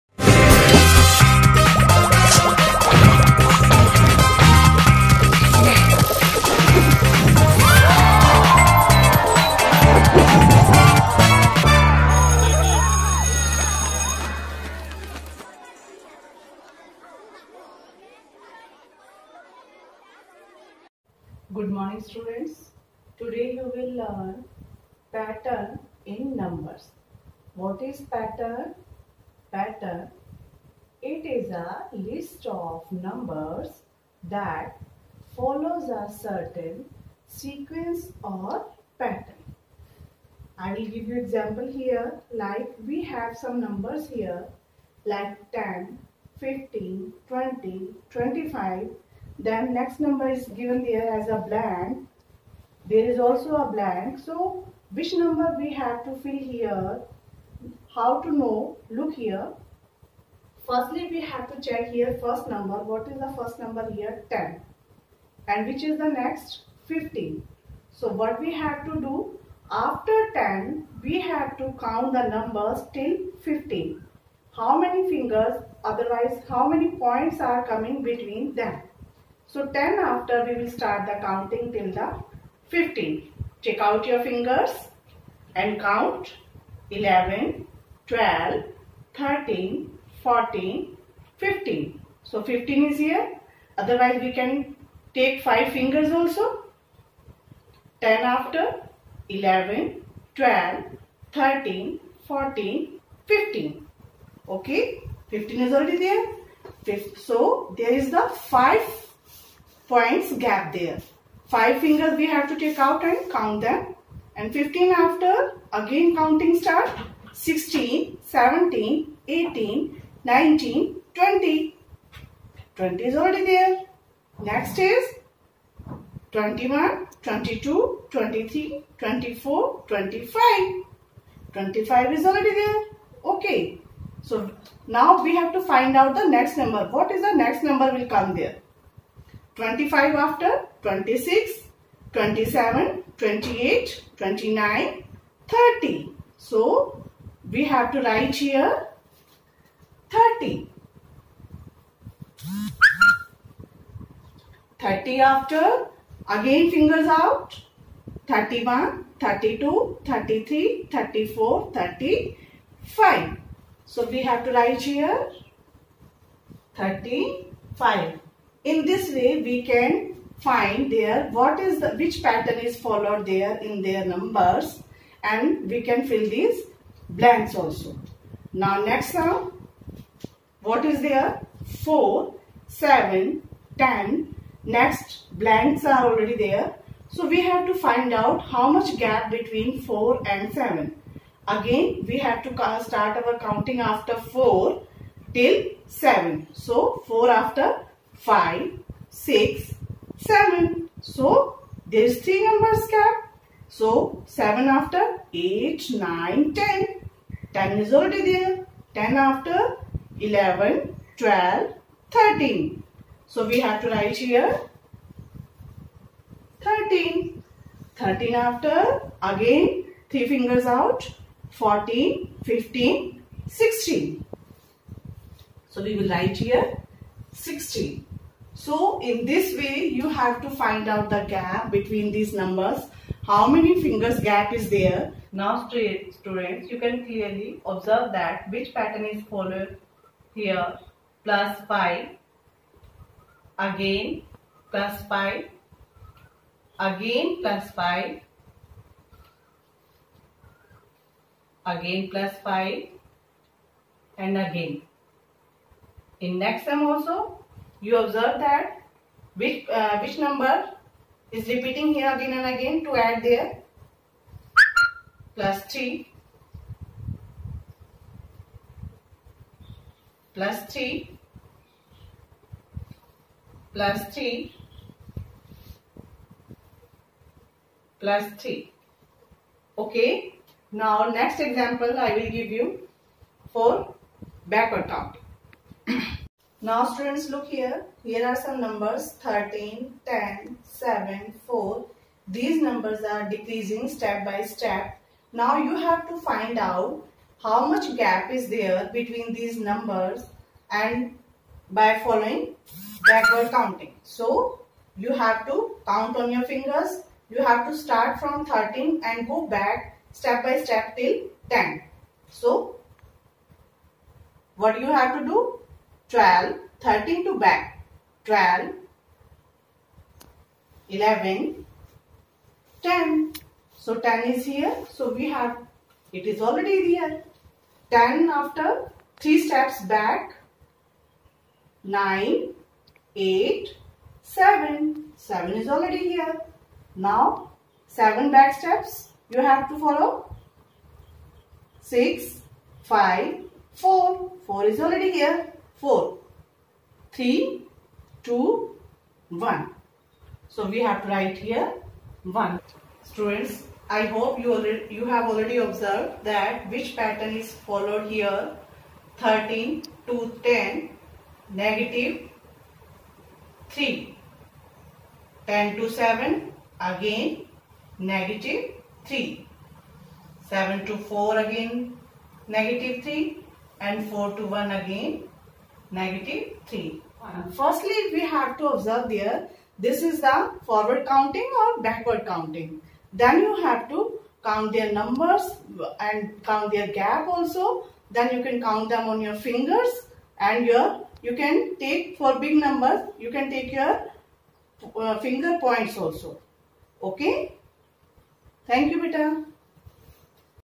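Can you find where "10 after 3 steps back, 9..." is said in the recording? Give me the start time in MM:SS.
05:27.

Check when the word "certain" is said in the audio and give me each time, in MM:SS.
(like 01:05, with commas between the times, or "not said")
00:36.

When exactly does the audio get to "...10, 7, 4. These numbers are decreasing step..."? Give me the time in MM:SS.
04:50.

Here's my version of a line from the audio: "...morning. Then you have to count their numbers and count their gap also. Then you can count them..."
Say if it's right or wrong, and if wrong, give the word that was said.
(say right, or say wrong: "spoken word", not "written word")
wrong: "counting", not "morning".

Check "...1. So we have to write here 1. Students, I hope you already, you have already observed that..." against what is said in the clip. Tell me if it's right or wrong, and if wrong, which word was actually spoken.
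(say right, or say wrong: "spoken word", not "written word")
right.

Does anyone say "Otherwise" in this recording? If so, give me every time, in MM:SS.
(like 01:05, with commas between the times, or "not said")
01:15, 01:33.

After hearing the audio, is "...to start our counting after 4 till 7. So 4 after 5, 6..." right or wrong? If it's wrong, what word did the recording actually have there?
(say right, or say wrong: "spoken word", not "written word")
right.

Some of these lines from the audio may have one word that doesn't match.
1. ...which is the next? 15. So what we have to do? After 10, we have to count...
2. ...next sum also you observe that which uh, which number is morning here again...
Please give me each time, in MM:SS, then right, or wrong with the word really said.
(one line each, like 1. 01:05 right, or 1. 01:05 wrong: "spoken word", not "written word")
1. 01:05 right
2. 04:16 wrong: "repeating", not "morning".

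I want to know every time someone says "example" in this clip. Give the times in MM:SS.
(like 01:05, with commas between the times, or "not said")
00:41, 04:41.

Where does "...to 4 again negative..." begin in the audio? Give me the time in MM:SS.
06:10.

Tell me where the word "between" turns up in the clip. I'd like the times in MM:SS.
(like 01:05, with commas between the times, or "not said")
01:18, 03:09, 03:51, 04:58.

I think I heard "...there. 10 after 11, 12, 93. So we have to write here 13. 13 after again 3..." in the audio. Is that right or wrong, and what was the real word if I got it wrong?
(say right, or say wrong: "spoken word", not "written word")
wrong: "13", not "93".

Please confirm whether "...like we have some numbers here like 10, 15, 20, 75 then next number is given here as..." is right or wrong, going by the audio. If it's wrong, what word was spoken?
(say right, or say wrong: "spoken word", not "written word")
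wrong: "25", not "75".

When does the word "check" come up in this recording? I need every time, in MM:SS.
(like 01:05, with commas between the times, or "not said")
01:01, 01:23.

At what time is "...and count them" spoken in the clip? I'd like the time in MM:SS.
01:53.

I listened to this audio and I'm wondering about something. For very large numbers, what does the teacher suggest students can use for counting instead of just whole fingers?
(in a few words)
finger points.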